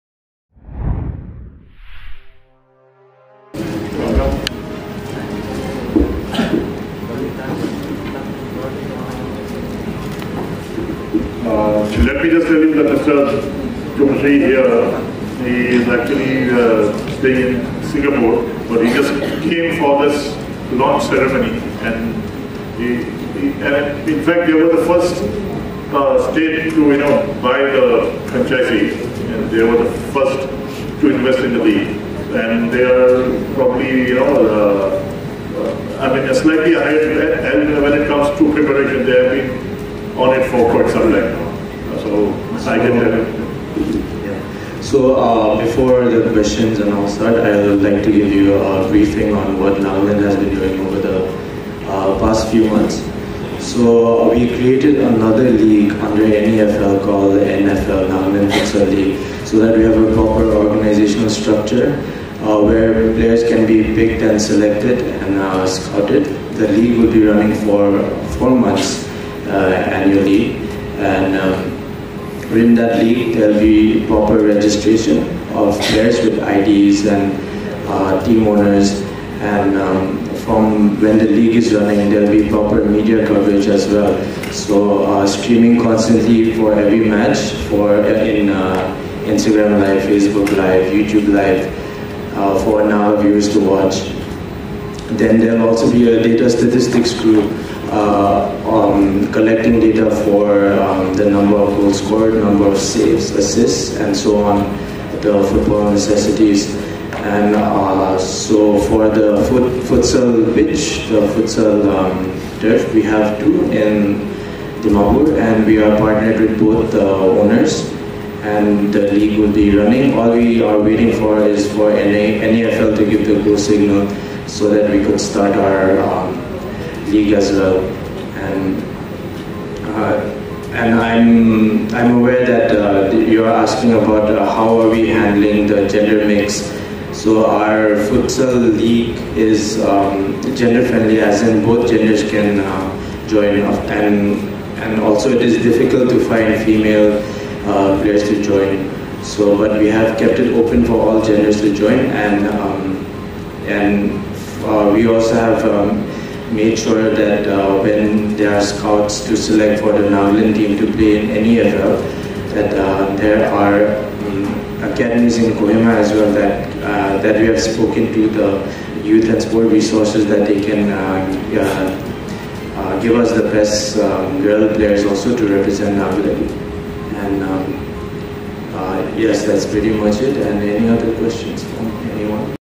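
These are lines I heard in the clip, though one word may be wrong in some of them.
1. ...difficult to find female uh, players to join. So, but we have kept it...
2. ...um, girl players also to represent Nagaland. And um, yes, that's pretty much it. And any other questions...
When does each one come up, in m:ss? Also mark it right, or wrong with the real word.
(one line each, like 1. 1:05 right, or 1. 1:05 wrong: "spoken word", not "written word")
1. 2:25 right
2. 2:53 right.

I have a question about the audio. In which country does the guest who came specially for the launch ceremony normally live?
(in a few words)
Singapore.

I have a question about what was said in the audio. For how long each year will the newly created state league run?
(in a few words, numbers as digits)
Four months.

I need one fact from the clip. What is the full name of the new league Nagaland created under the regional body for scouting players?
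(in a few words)
Nagaland Futsal League.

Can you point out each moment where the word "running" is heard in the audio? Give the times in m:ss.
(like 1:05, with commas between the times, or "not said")
1:07, 1:21, 1:59.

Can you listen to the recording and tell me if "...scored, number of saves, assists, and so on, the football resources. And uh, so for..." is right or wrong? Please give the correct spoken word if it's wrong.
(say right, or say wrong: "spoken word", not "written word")
wrong: "necessities", not "resources".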